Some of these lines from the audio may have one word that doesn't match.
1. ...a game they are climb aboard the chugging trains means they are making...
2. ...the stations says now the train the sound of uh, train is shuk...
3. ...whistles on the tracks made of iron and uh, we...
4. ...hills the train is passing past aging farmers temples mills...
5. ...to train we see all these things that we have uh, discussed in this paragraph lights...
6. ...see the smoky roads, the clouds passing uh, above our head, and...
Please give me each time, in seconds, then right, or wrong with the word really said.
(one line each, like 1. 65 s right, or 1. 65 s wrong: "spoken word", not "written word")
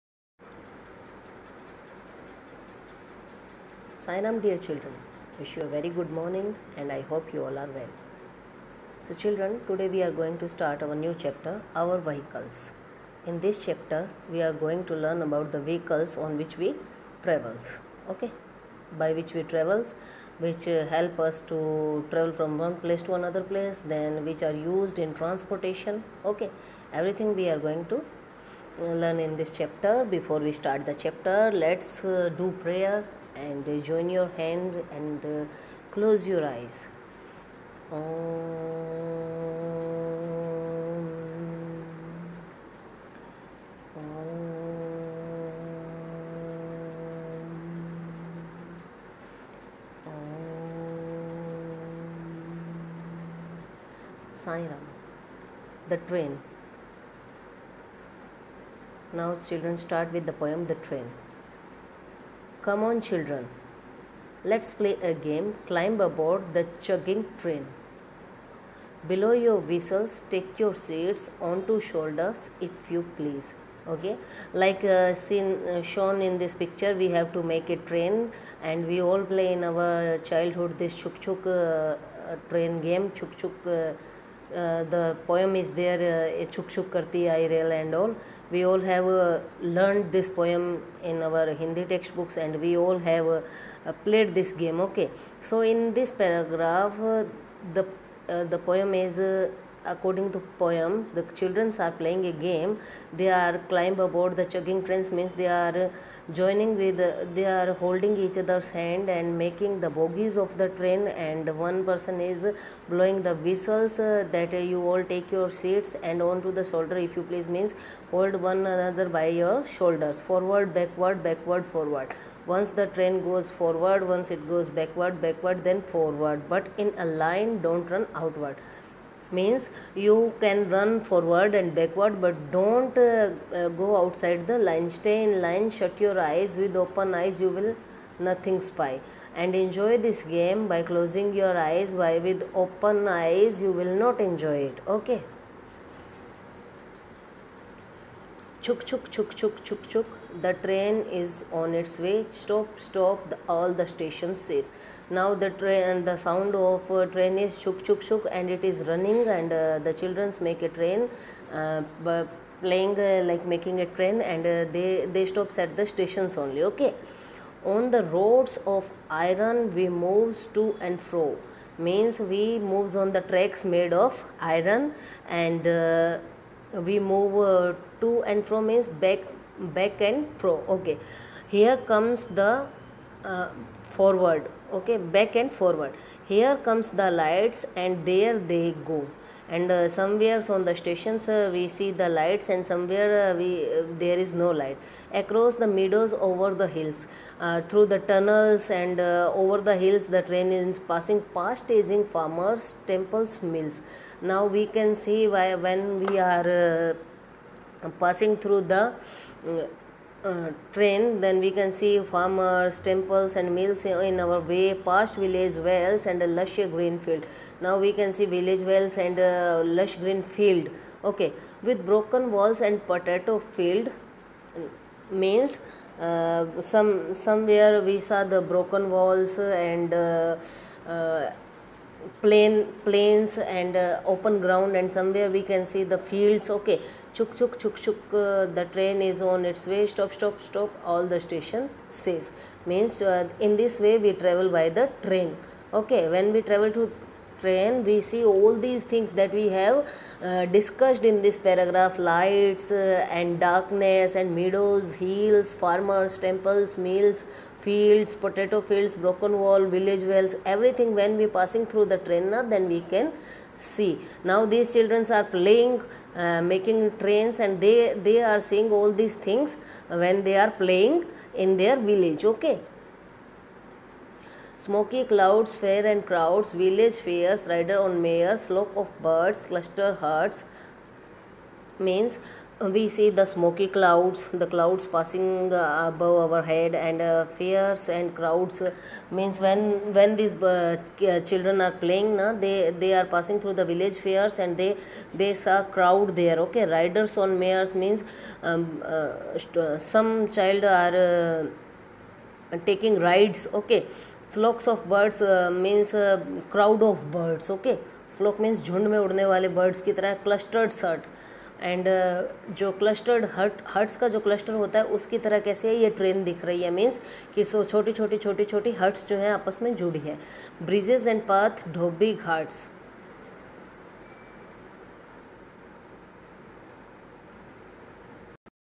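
1. 102 s wrong: "joining", not "making"
2. 153 s right
3. 172 s wrong: "moves", not "whistles"
4. 199 s right
5. 246 s right
6. 282 s wrong: "clouds", not "roads".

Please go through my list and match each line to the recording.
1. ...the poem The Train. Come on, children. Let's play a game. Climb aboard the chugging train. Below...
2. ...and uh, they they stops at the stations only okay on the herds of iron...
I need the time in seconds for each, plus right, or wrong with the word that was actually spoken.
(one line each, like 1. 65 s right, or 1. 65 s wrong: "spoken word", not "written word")
1. 60 s right
2. 164 s wrong: "roads", not "herds".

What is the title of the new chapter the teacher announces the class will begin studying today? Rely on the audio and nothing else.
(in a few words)
Our Vehicles.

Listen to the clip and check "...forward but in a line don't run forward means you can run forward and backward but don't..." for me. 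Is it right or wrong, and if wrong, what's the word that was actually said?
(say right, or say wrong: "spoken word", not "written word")
wrong: "outward", not "forward".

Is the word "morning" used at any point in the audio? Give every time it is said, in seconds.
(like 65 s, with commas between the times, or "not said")
6 s.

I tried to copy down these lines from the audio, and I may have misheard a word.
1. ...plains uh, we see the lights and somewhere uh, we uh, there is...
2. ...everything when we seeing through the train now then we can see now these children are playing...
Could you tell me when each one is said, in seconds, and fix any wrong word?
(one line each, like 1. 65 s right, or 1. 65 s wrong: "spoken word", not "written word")
1. 190 s wrong: "stations", not "plains"
2. 260 s wrong: "passing", not "seeing".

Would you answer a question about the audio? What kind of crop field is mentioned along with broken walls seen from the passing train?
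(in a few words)
Potato field.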